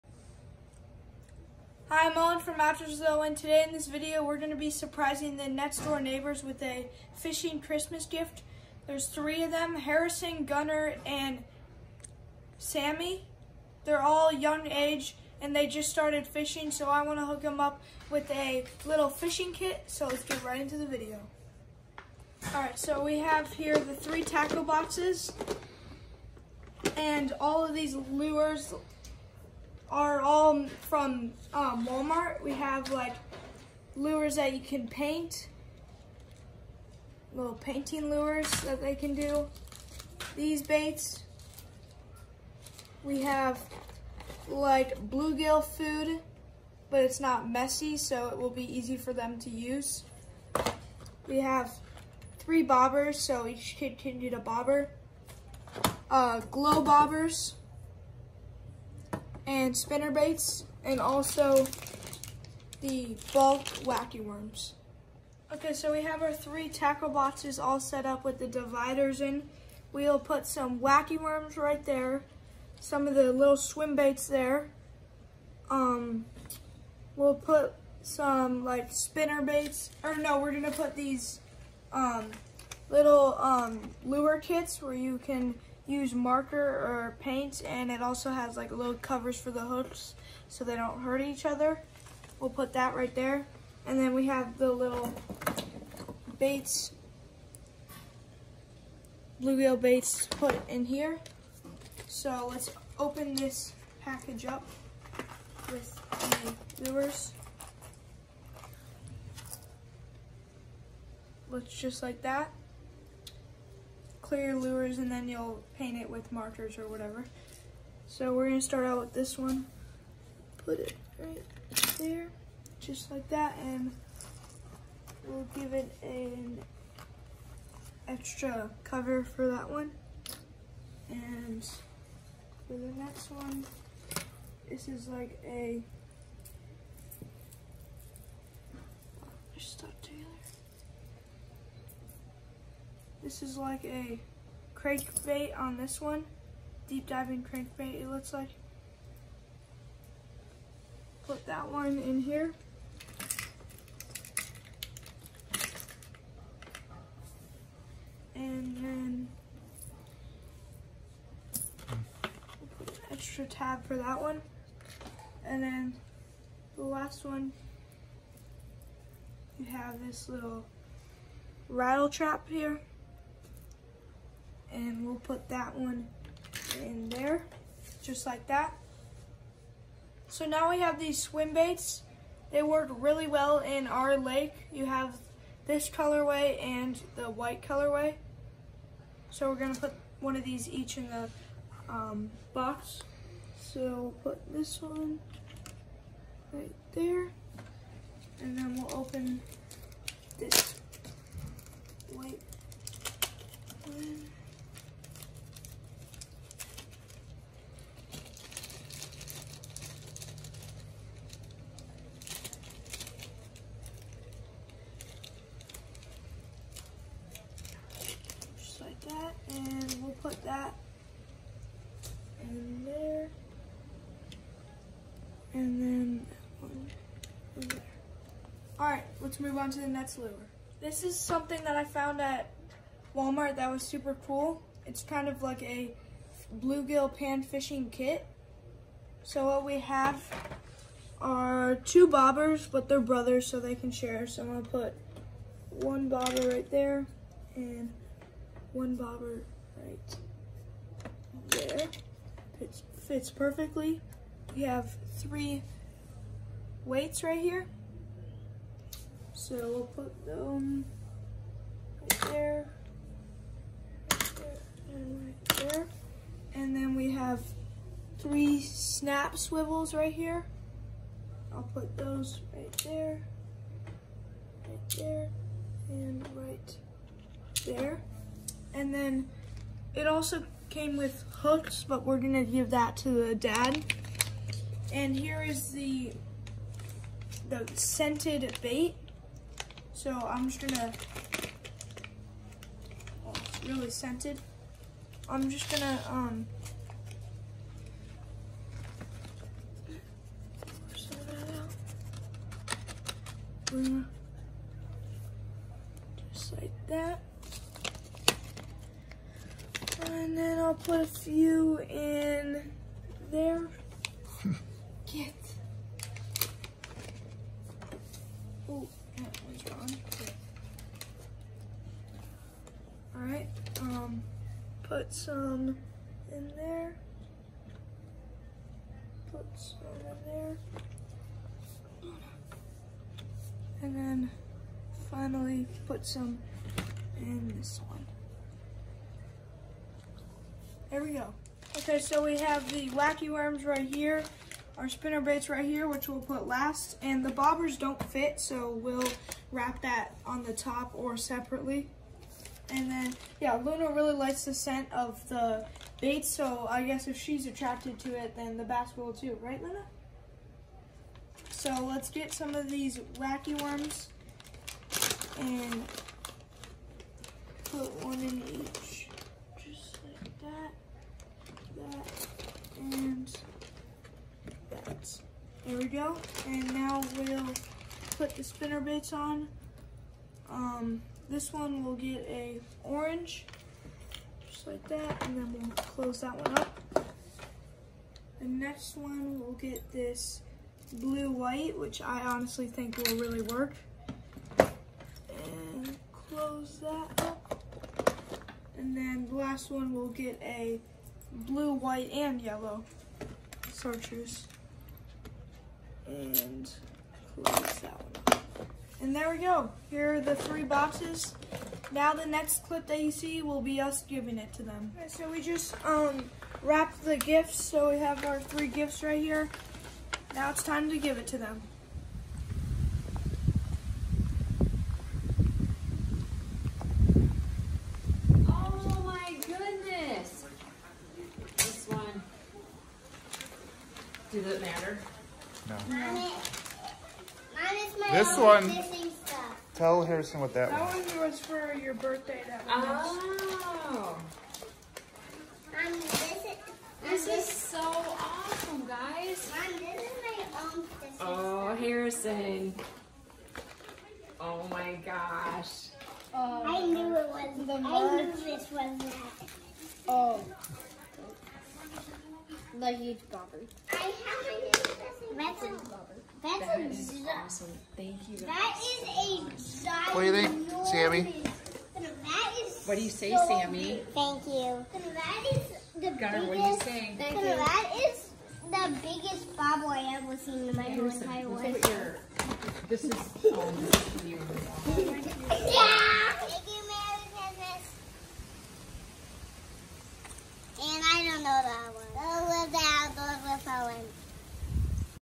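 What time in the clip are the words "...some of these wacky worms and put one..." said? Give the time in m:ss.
6:02.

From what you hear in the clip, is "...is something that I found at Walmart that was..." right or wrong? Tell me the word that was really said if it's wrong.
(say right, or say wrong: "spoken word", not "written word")
right.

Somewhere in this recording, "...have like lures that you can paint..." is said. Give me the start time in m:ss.
0:32.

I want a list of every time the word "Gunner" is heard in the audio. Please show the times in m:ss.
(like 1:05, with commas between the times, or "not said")
0:10, 7:56.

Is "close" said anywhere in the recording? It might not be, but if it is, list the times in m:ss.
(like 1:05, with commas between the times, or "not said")
6:25, 6:36, 6:47.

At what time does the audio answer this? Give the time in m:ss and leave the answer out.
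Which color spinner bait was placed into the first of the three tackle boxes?
6:22.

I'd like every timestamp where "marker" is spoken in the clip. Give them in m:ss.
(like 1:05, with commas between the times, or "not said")
1:26, 1:56.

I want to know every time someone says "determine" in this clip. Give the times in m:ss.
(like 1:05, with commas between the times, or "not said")
not said.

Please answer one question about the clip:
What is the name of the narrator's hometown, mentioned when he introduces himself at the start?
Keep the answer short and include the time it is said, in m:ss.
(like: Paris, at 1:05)
Matchersville, at 0:02.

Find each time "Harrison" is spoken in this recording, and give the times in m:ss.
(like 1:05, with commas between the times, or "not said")
0:09, 7:20, 7:31.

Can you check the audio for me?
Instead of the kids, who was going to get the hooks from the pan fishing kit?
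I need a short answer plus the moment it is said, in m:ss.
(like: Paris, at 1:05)
The dad, at 4:43.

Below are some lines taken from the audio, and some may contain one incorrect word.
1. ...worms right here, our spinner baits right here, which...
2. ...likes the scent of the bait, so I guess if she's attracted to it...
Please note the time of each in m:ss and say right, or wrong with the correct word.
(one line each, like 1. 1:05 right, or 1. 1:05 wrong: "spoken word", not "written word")
1. 5:43 right
2. 5:54 right.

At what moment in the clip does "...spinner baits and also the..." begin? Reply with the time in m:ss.
0:59.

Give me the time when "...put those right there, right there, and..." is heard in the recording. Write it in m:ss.
4:31.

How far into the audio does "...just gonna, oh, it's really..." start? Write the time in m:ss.
4:50.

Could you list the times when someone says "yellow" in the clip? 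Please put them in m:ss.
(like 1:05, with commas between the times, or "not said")
6:42.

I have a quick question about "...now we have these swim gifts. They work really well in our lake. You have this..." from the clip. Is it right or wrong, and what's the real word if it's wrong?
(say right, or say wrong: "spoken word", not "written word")
wrong: "baits", not "gifts".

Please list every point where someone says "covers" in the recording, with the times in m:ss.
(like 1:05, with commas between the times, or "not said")
1:28, 2:08.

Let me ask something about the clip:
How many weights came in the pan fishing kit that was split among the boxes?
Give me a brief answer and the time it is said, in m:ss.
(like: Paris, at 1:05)
3, at 4:15.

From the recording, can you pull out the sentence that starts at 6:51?
Now the next clip that you see will be us giving it to them.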